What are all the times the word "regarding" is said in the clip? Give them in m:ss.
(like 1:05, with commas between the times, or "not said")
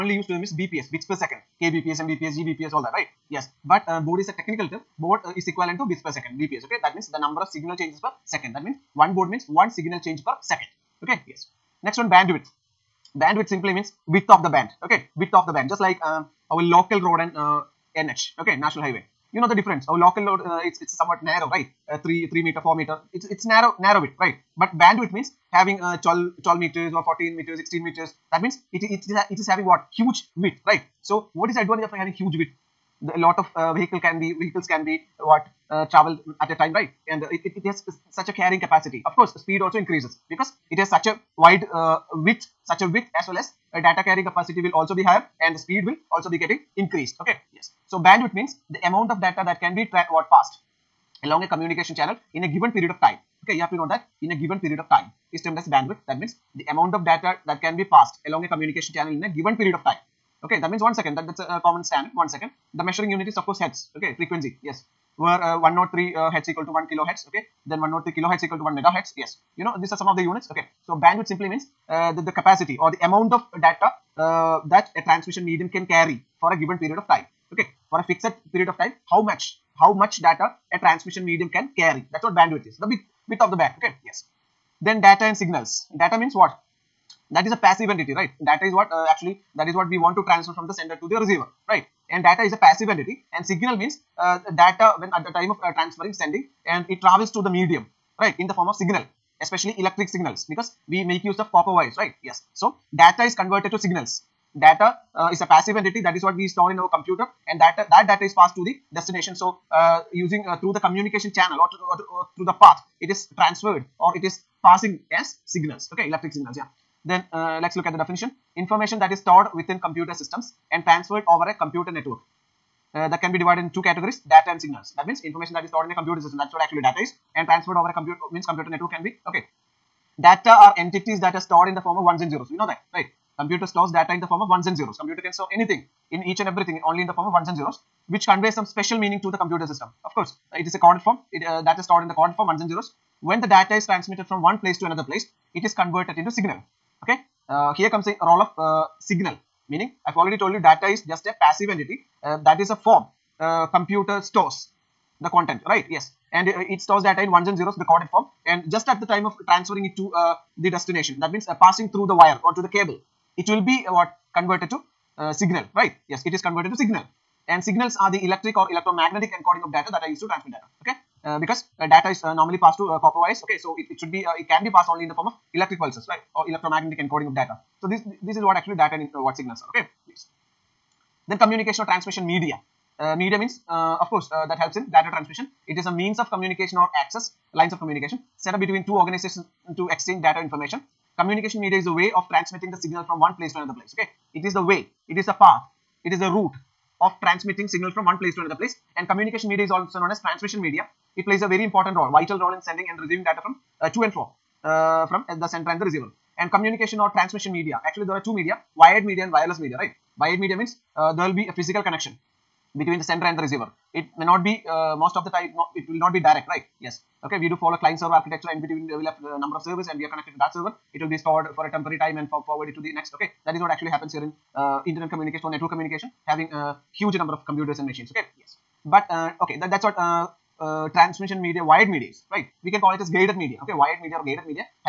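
not said.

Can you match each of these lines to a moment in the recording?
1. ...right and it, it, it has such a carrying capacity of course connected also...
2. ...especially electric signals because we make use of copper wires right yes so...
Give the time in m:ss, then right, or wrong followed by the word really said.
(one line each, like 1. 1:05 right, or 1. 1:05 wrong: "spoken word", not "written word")
1. 0:36 wrong: "speed", not "connected"
2. 1:39 right.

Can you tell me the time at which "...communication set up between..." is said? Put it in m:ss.
3:07.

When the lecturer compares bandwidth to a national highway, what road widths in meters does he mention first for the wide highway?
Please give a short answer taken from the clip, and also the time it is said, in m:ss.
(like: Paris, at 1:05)
12 meters, at 0:26.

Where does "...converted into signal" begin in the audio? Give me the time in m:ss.
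2:25.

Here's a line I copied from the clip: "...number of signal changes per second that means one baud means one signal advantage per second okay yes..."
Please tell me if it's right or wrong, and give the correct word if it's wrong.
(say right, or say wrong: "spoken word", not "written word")
wrong: "change", not "advantage".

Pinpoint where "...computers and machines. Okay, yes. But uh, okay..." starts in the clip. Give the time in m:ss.
3:47.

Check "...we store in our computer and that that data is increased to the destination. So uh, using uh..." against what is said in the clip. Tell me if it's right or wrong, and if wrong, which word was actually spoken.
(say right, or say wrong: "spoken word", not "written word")
wrong: "passed", not "increased".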